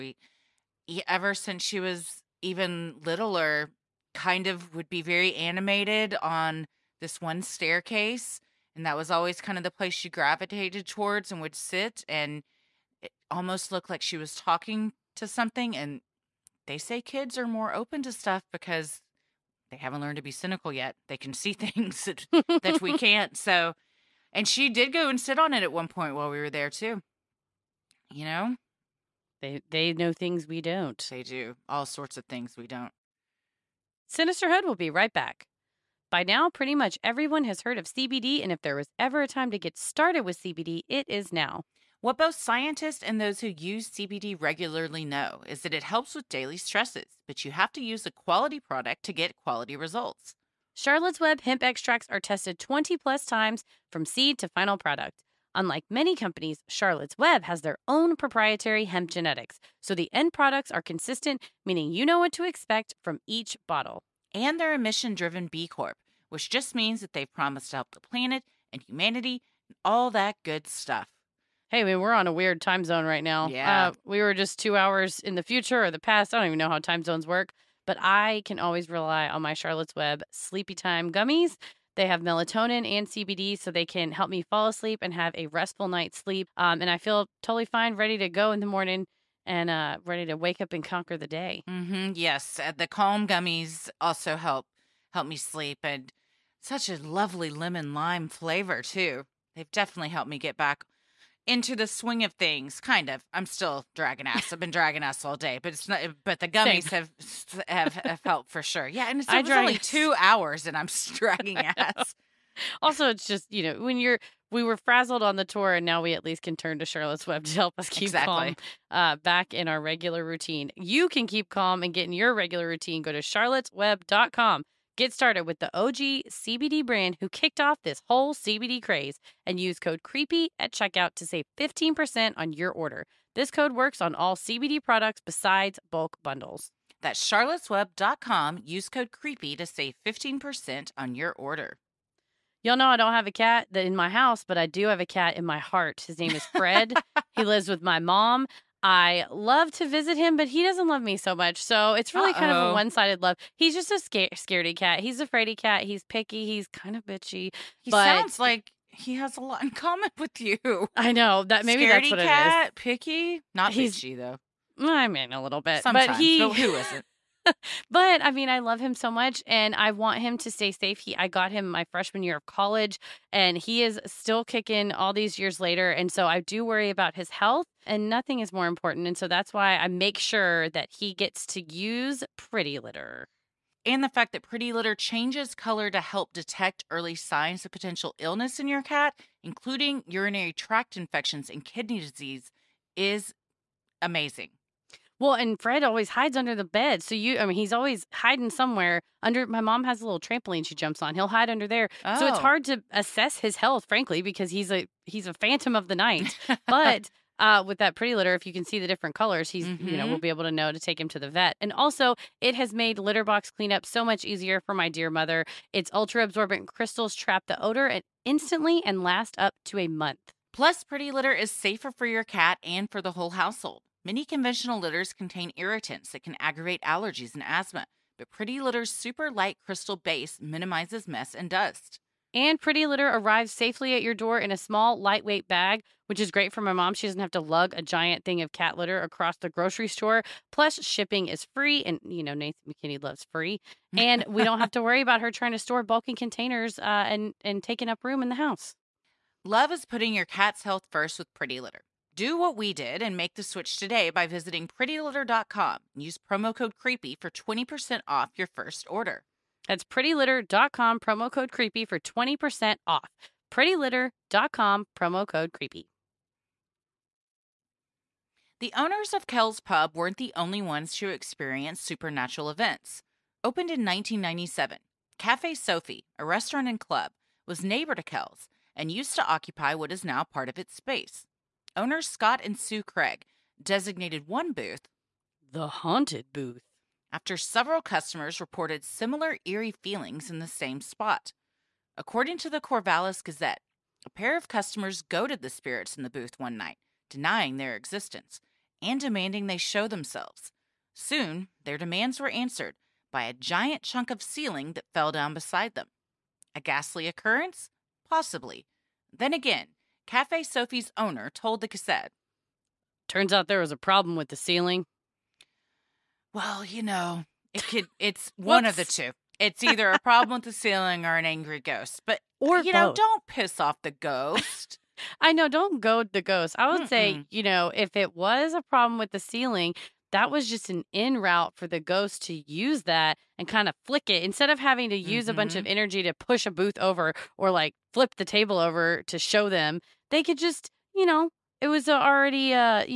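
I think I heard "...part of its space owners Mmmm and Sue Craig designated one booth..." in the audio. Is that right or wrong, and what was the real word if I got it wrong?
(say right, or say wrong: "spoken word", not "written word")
wrong: "Scott", not "Mmmm".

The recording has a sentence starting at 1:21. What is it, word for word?
They have melatonin and CBD, so they can help me fall asleep and have a restful night's sleep.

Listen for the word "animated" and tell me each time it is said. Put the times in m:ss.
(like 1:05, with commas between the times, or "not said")
0:05.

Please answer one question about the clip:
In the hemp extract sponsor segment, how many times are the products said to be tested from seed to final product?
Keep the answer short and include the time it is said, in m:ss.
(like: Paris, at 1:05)
20+, at 0:52.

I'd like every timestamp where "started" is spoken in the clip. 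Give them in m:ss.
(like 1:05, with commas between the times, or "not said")
0:39, 2:05.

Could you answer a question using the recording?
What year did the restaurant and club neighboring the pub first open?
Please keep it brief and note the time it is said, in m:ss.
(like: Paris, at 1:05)
1997, at 4:33.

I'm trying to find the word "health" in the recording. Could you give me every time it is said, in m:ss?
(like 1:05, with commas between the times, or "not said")
2:57, 3:23, 4:10.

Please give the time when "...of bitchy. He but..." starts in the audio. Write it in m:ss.
2:36.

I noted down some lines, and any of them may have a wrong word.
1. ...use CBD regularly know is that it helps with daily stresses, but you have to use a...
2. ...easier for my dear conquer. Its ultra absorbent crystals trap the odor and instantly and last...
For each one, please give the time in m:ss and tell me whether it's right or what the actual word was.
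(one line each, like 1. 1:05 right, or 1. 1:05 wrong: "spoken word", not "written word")
1. 0:43 right
2. 3:34 wrong: "mother", not "conquer".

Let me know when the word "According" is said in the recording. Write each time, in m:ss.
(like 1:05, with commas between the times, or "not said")
4:51.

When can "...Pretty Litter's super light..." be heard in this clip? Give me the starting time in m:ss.
3:48.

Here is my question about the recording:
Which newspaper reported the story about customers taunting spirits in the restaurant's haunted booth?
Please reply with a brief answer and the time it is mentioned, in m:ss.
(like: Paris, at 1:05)
Corvallis Gazette, at 4:52.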